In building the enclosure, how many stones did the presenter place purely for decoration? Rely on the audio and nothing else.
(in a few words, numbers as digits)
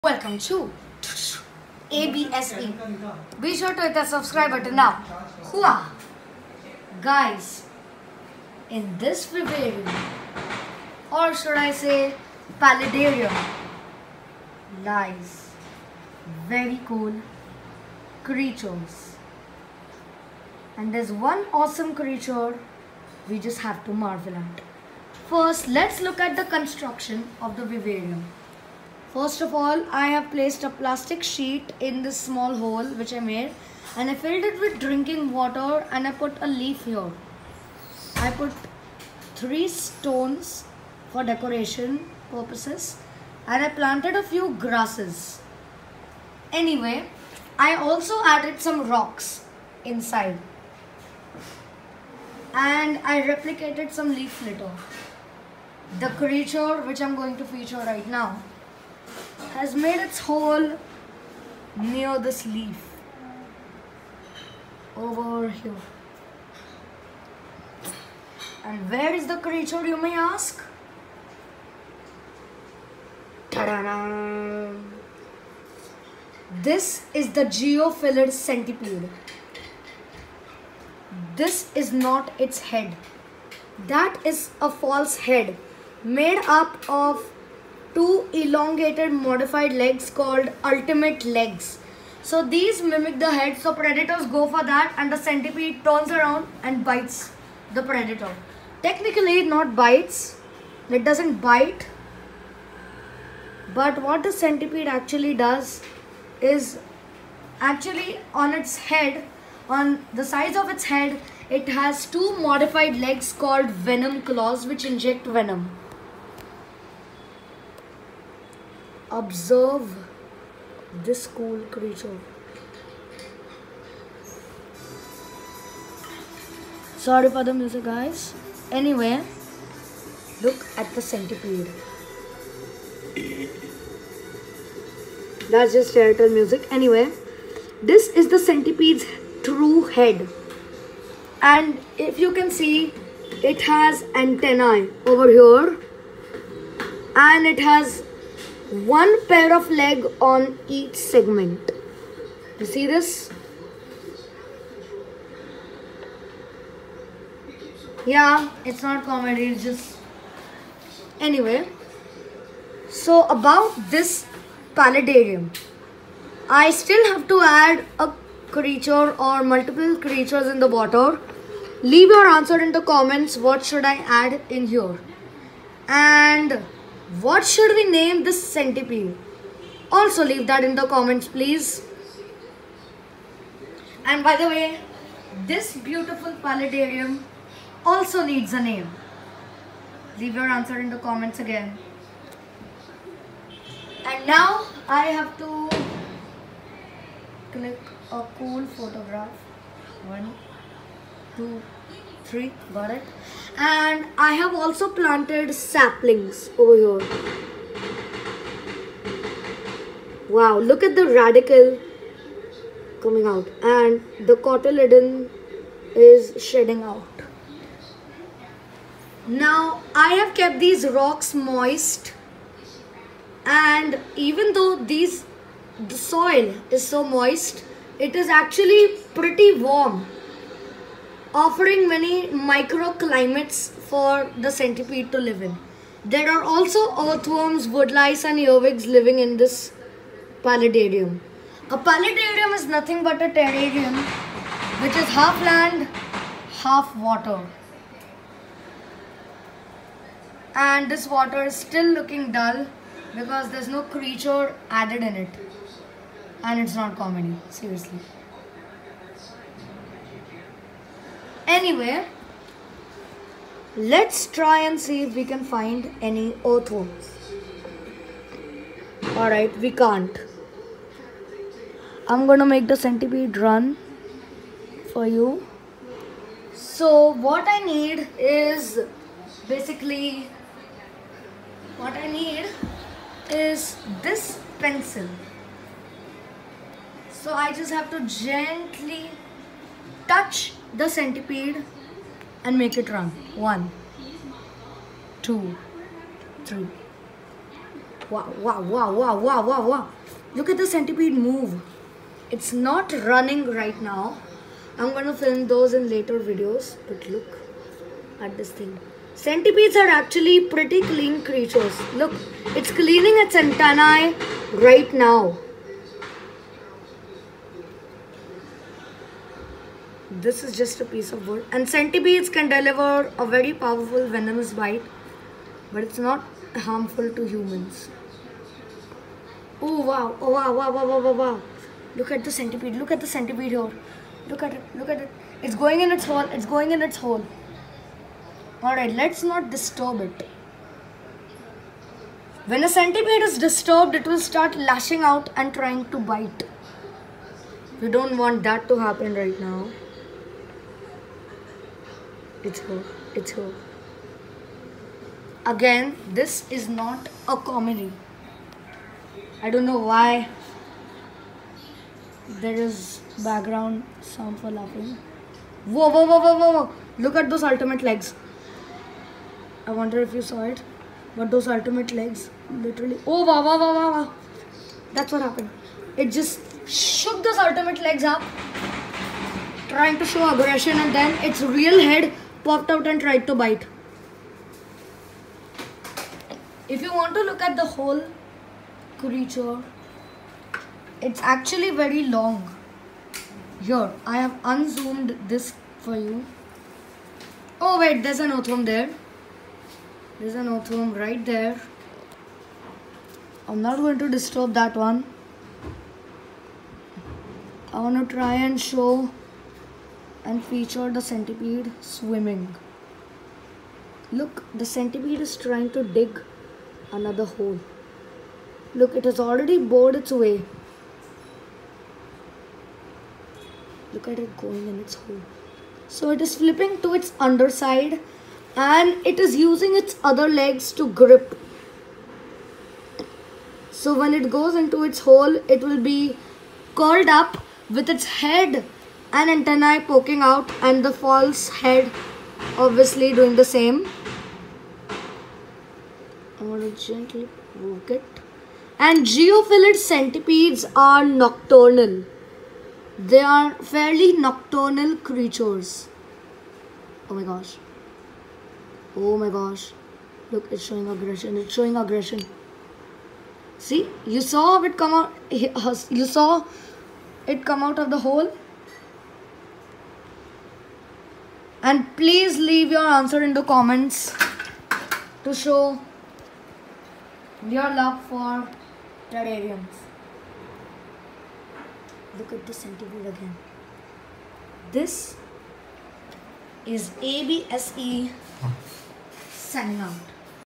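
3.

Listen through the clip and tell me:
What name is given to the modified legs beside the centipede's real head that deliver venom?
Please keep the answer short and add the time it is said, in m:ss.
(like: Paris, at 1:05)
venom claws, at 1:53.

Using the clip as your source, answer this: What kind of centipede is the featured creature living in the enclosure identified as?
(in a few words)
geophilid centipede.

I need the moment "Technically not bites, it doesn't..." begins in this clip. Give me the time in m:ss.
1:38.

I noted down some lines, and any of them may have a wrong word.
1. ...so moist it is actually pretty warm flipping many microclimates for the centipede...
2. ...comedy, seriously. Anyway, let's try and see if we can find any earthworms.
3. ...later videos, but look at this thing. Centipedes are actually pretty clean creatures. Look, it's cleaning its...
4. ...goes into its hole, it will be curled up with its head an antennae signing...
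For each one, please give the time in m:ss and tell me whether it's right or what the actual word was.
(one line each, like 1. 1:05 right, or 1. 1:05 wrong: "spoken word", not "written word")
1. 3:46 wrong: "offering", not "flipping"
2. 4:16 right
3. 5:05 right
4. 7:14 wrong: "poking", not "signing".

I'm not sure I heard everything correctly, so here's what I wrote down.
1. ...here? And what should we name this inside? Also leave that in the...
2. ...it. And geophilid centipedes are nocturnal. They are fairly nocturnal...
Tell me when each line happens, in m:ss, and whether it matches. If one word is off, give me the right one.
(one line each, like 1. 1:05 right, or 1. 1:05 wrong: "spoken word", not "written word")
1. 2:54 wrong: "centipede", not "inside"
2. 7:27 right.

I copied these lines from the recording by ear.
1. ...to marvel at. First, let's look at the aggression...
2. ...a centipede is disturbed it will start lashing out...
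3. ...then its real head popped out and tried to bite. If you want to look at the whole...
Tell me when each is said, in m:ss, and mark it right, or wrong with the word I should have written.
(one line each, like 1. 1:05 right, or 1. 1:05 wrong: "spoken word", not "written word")
1. 0:23 wrong: "construction", not "aggression"
2. 5:42 right
3. 6:21 right.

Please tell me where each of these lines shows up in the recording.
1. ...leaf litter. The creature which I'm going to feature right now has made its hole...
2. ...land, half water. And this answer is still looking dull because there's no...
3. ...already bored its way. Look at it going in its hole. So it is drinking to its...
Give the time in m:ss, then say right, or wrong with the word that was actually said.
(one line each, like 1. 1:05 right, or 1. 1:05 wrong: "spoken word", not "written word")
1. 0:54 right
2. 4:05 wrong: "water", not "answer"
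3. 6:59 wrong: "flipping", not "drinking".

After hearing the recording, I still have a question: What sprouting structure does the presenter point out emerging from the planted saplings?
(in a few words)
radicle.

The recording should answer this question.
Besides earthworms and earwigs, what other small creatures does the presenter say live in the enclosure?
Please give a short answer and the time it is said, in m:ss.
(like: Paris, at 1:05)
woodlice, at 3:57.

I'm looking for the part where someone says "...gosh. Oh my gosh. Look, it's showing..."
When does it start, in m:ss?
7:37.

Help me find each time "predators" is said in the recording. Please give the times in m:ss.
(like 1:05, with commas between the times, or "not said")
1:33, 1:37.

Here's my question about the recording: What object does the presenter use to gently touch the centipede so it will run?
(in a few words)
pencil.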